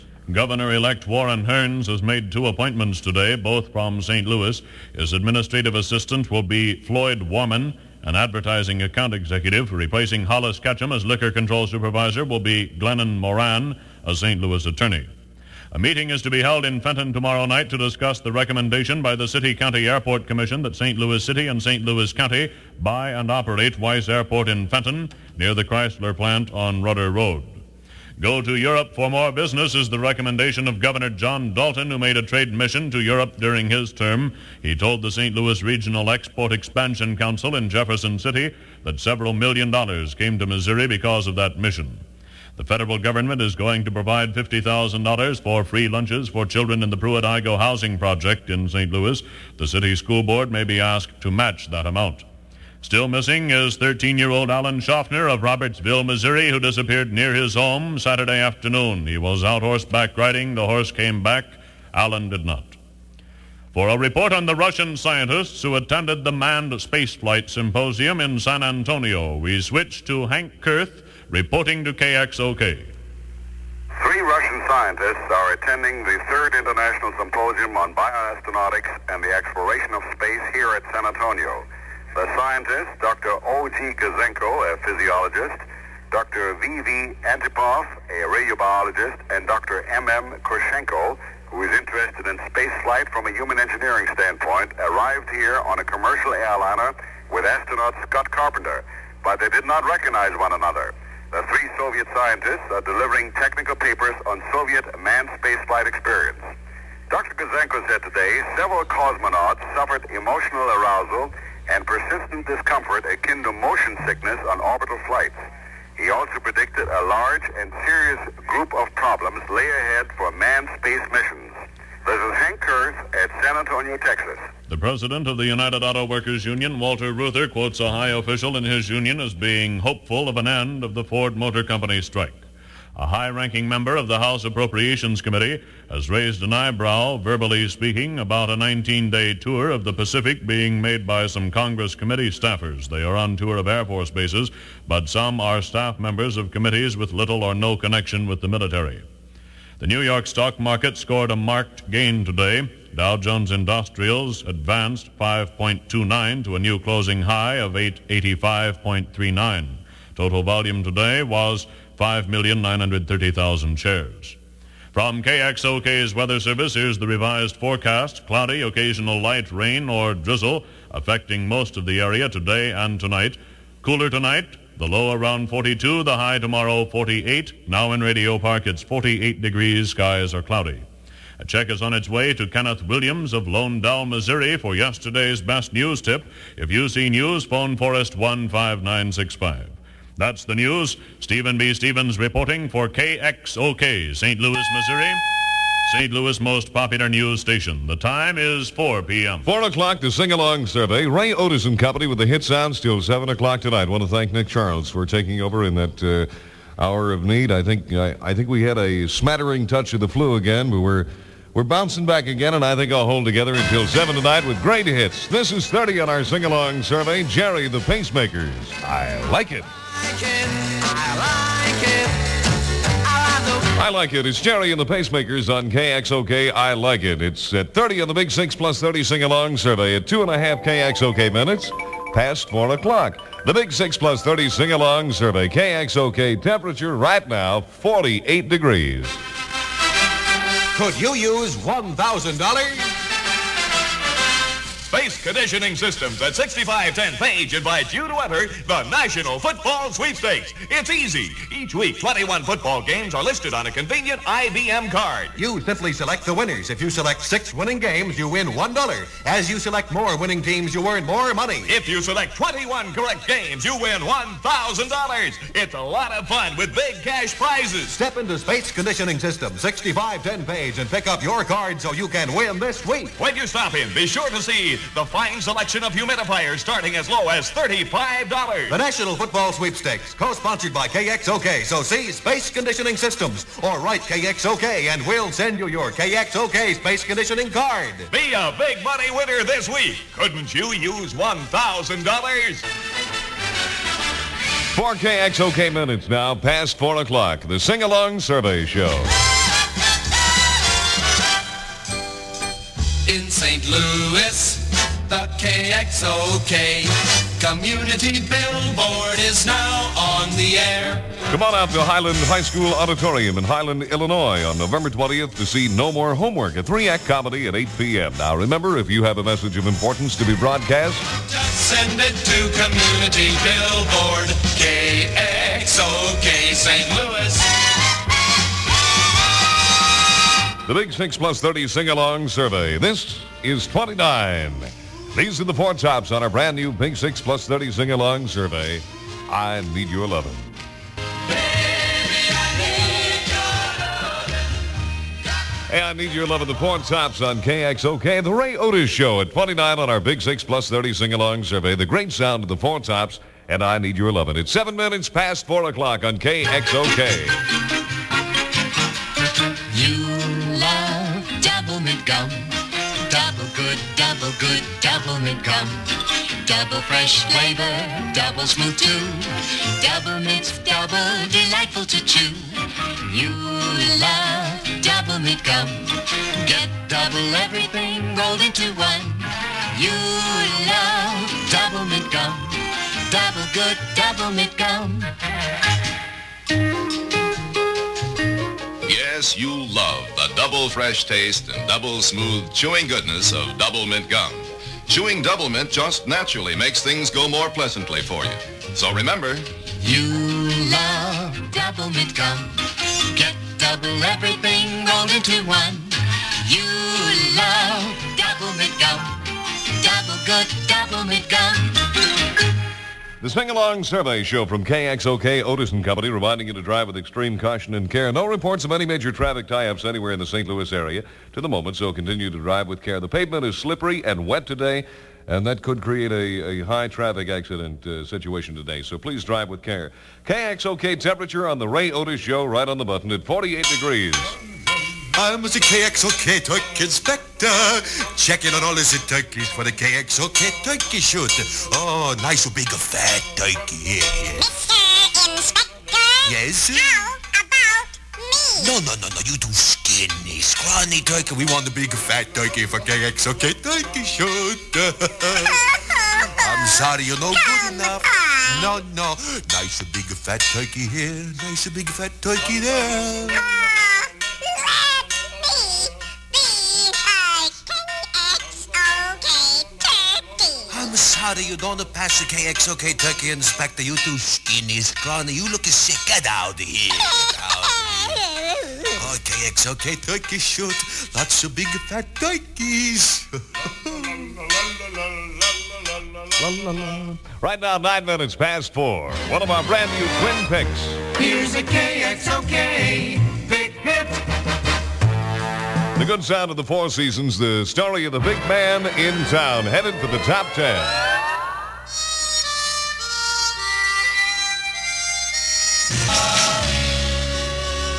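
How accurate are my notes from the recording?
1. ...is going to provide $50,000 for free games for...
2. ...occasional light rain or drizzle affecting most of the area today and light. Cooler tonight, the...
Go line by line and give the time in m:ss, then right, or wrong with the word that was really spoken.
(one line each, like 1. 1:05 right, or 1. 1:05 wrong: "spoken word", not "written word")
1. 0:43 wrong: "lunches", not "games"
2. 2:48 wrong: "tonight", not "light".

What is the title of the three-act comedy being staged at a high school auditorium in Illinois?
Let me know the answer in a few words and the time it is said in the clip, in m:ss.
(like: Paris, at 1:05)
No More Homework, at 5:15.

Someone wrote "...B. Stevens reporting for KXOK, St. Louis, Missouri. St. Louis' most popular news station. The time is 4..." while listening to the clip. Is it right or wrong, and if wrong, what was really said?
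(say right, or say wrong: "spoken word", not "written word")
right.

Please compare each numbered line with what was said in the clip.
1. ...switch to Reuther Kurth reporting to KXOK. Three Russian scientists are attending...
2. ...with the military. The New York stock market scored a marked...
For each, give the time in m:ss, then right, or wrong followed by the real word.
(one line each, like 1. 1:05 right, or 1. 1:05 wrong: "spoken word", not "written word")
1. 1:09 wrong: "Hank", not "Reuther"
2. 2:28 right.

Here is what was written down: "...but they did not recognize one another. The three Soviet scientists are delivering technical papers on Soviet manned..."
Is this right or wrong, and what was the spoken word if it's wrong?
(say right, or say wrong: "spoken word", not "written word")
right.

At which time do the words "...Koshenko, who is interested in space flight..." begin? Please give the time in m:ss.
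1:30.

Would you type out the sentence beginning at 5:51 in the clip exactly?
The great sound of the Four tops, and I need your love.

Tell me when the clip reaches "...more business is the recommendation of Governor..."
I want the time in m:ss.
0:29.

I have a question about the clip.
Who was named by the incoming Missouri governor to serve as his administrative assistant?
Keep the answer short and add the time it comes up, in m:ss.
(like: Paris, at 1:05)
Floyd Warman, at 0:06.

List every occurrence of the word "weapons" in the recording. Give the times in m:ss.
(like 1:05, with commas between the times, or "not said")
not said.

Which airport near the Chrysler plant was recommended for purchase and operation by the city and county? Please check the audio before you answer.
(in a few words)
Weiss Airport.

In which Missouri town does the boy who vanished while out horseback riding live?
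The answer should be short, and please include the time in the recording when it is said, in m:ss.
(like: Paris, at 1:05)
Robertsville, at 0:55.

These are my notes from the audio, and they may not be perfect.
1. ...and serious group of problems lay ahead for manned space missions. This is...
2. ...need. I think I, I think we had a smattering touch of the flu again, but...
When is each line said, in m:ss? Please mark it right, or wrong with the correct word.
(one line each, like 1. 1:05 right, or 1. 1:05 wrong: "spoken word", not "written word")
1. 1:57 right
2. 3:27 right.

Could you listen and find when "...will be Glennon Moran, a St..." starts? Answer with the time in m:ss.
0:12.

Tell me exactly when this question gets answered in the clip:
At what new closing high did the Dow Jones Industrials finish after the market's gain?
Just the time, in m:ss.
2:37.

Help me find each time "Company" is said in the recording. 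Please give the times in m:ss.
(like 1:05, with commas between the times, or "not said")
2:11, 3:21, 6:55.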